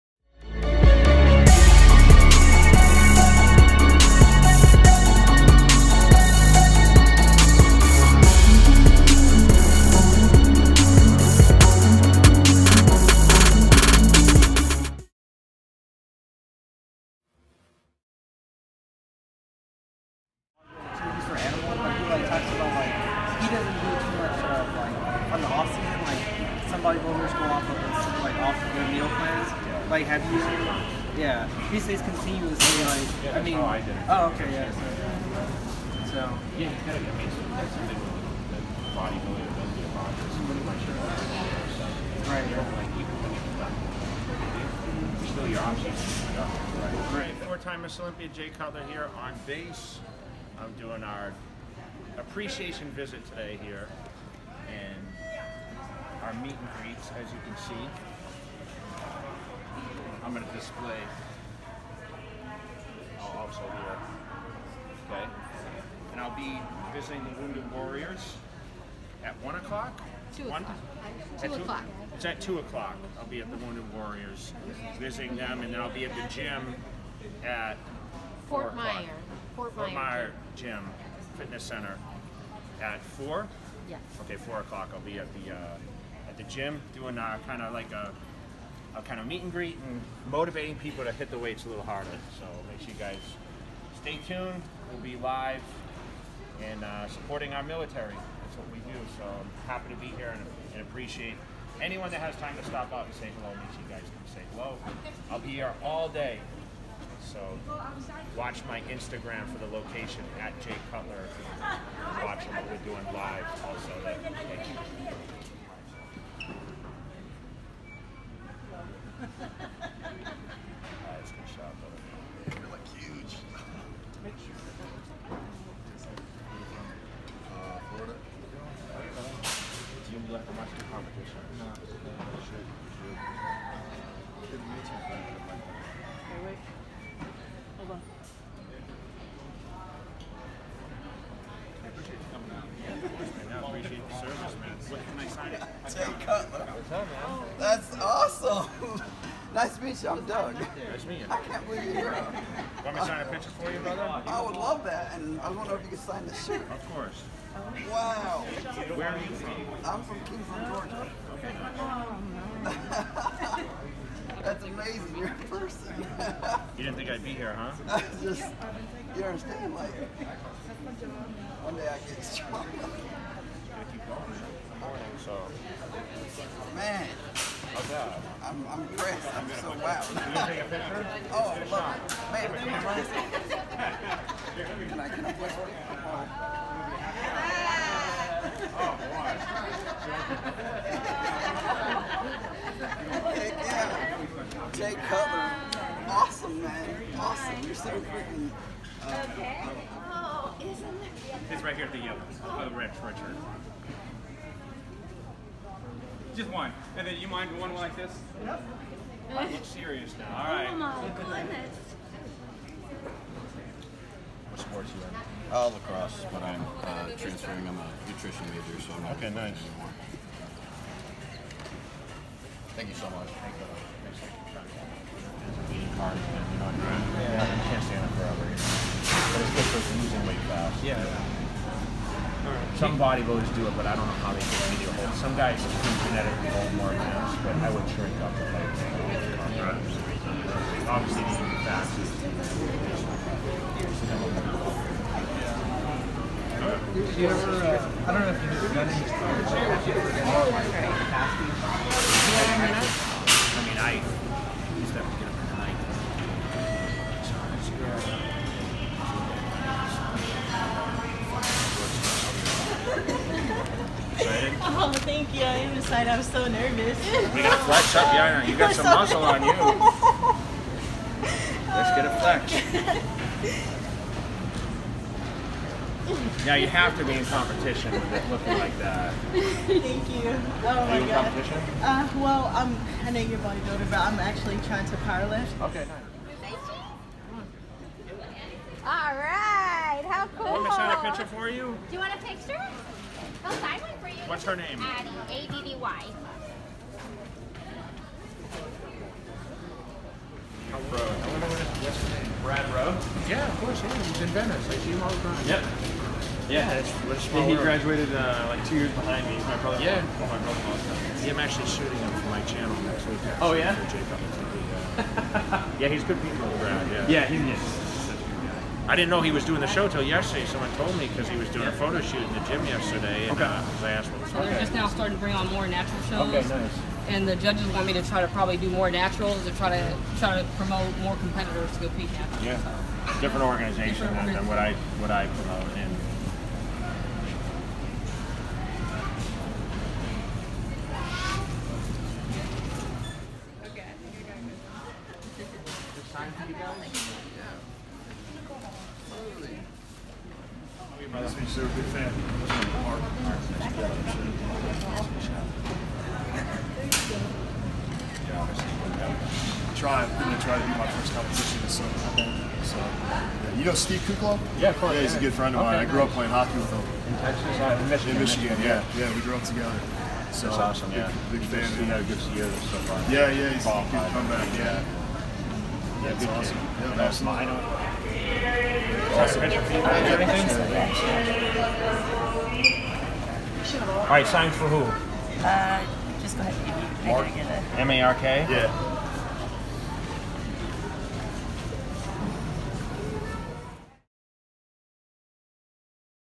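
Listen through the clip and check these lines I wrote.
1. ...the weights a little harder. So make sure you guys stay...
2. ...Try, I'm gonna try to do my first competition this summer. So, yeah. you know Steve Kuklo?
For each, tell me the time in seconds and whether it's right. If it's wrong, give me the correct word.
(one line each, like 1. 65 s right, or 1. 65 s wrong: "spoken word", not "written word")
1. 91 s right
2. 359 s right.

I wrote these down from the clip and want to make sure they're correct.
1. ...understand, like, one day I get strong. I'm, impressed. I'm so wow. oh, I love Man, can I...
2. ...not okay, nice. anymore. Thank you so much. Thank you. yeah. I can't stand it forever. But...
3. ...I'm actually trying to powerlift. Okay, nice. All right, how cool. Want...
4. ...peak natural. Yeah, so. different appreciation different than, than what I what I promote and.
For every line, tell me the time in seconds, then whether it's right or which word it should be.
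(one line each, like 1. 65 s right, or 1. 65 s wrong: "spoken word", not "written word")
1. 169 s right
2. 219 s right
3. 283 s right
4. 331 s wrong: "organization", not "appreciation".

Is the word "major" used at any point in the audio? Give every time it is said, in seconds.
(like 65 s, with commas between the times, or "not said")
218 s.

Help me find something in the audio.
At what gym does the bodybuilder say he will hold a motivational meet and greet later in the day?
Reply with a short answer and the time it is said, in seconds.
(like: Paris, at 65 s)
Fort Myer Gym Fitness Center, at 79 s.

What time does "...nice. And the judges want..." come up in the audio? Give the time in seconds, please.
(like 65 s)
326 s.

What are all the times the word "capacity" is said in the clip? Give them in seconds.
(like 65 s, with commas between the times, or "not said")
249 s.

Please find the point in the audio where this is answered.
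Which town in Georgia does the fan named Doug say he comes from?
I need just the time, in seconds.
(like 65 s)
160 s.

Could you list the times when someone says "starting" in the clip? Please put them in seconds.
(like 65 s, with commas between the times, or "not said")
324 s.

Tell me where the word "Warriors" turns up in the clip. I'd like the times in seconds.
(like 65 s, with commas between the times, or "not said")
67 s, 73 s.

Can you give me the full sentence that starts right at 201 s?
It's right here at the yellow.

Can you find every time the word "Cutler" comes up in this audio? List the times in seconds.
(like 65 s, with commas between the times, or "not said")
48 s, 110 s, 146 s, 195 s.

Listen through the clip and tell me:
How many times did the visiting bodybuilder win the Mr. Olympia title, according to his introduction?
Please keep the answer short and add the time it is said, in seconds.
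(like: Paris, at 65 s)
4, at 47 s.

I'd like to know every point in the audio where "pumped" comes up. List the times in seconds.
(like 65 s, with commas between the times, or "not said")
not said.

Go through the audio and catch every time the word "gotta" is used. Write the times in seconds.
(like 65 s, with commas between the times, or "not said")
267 s.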